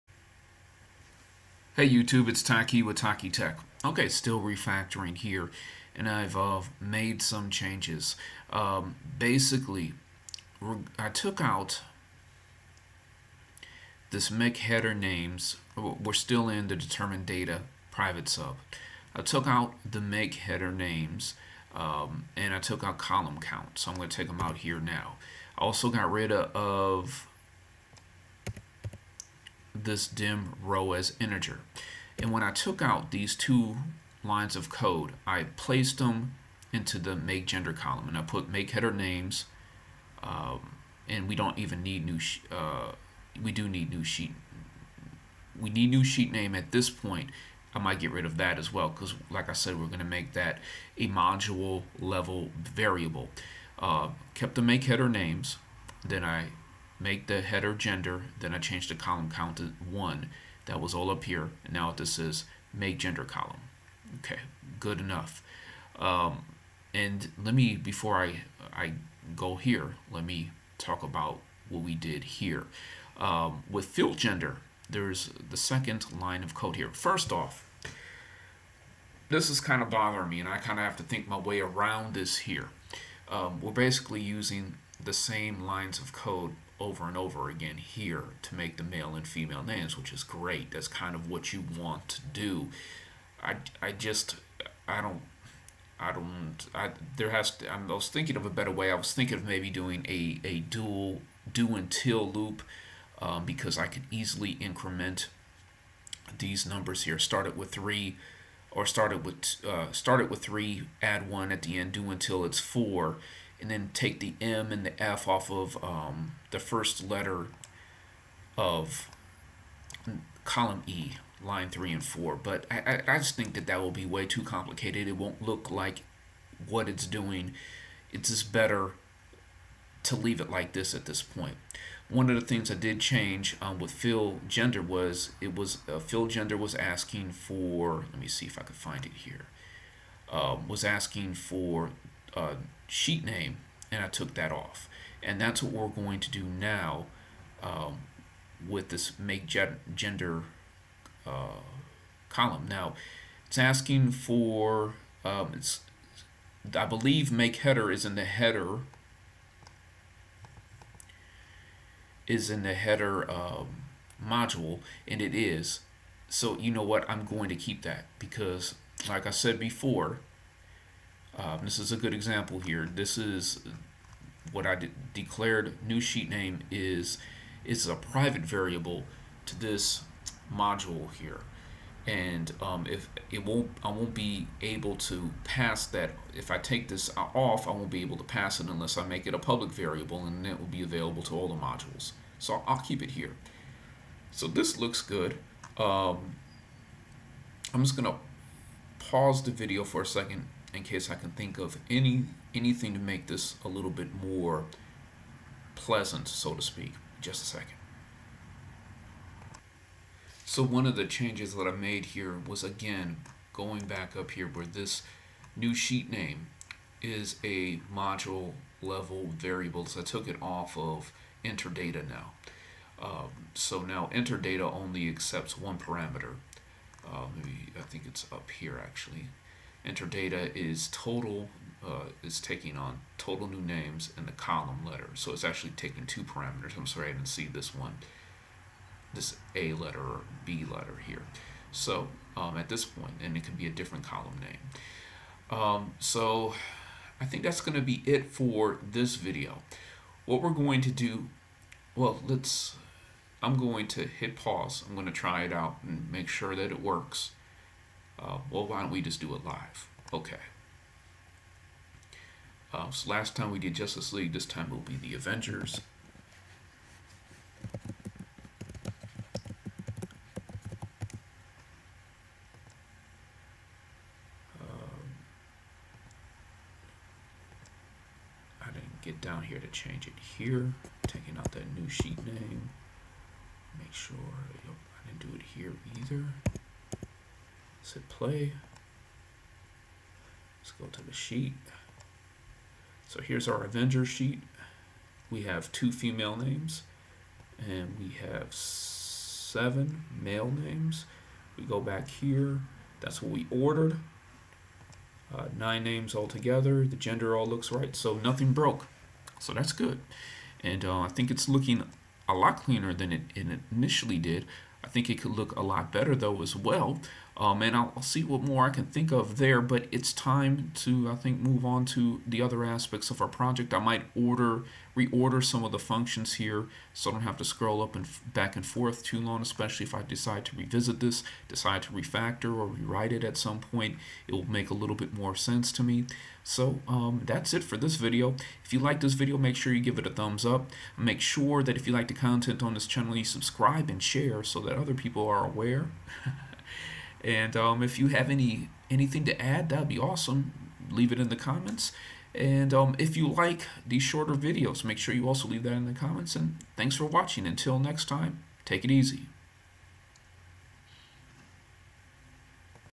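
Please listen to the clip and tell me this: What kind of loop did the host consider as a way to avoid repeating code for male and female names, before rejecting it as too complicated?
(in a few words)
Do until loop.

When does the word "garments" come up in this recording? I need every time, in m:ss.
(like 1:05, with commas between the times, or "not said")
not said.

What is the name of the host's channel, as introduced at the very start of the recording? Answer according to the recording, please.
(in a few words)
Taqi Tech.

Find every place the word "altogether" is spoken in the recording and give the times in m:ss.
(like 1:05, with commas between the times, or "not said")
5:06.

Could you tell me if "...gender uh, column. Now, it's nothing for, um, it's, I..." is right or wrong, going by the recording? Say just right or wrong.
wrong.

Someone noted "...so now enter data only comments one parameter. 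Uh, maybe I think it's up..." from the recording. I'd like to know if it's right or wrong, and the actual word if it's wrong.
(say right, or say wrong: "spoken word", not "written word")
wrong: "accepts", not "comments".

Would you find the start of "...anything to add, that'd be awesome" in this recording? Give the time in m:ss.
5:48.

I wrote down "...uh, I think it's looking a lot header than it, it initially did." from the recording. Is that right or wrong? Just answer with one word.
wrong.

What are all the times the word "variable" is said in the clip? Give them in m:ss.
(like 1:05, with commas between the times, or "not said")
0:52, 2:58, 3:09, 3:39.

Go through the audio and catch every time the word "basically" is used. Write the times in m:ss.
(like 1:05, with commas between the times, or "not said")
0:09, 1:23.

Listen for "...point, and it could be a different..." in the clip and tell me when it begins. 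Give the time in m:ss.
4:02.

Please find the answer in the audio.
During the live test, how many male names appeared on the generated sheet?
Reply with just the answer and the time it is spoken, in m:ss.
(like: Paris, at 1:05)
7, at 4:58.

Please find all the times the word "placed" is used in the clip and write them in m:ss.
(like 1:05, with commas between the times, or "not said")
0:35.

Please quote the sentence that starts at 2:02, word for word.
But I, I just think that that will be way too complicated.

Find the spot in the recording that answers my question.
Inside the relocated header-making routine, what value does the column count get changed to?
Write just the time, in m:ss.
0:59.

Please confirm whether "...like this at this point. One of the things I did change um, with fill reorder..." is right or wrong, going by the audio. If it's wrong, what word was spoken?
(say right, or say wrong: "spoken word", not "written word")
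wrong: "gender", not "reorder".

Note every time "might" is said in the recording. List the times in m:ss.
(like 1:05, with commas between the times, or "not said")
0:47, 5:23.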